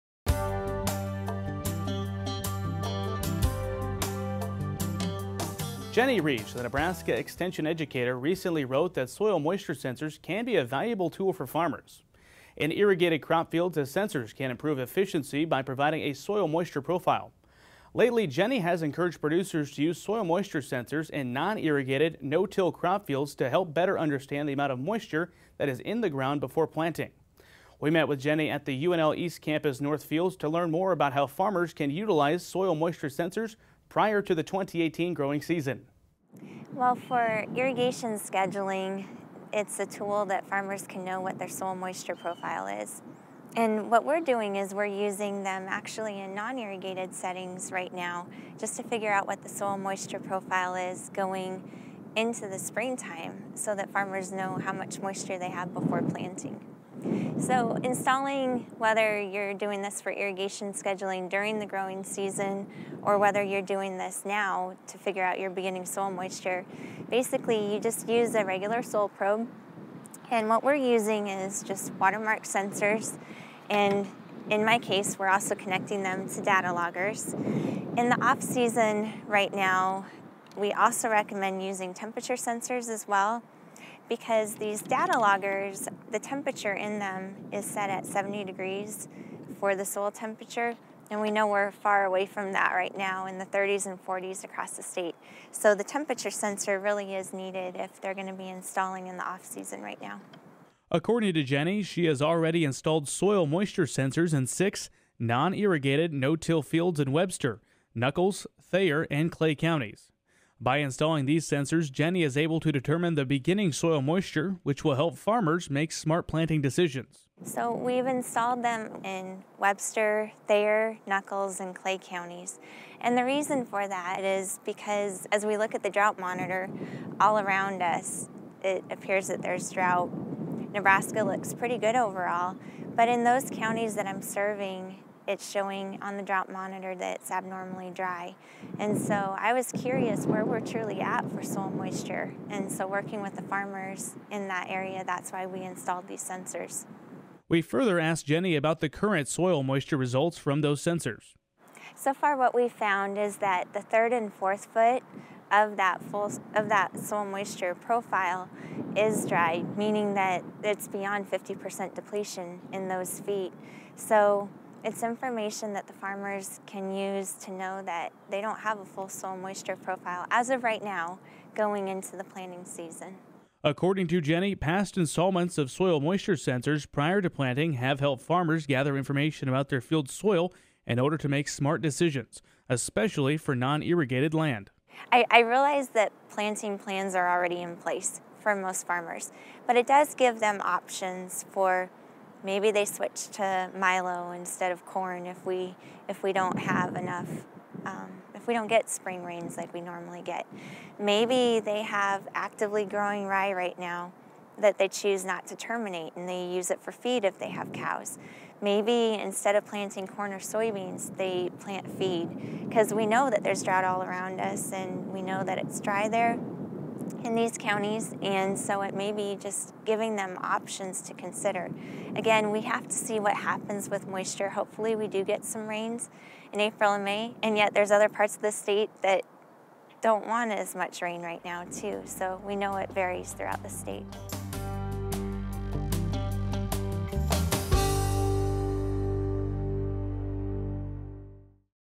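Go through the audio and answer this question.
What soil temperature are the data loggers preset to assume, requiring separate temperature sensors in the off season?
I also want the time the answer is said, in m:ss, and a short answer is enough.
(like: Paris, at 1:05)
70 degrees, at 1:28.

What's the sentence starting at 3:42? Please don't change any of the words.
Again, we have to see what happens with moisture.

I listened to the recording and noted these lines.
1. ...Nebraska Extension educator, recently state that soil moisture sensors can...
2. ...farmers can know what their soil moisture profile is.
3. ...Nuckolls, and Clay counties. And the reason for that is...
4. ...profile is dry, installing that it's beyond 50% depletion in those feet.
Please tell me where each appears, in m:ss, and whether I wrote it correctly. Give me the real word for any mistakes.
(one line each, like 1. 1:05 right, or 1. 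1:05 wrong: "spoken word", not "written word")
1. 0:06 wrong: "wrote", not "state"
2. 0:40 right
3. 2:01 right
4. 2:37 wrong: "meaning", not "installing".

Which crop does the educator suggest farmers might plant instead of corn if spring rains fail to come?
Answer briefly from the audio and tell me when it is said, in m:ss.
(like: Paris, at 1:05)
Milo, at 3:13.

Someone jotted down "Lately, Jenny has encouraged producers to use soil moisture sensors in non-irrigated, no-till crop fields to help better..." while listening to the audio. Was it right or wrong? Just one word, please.
right.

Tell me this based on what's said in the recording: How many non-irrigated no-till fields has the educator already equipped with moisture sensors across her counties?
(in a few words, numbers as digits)
6.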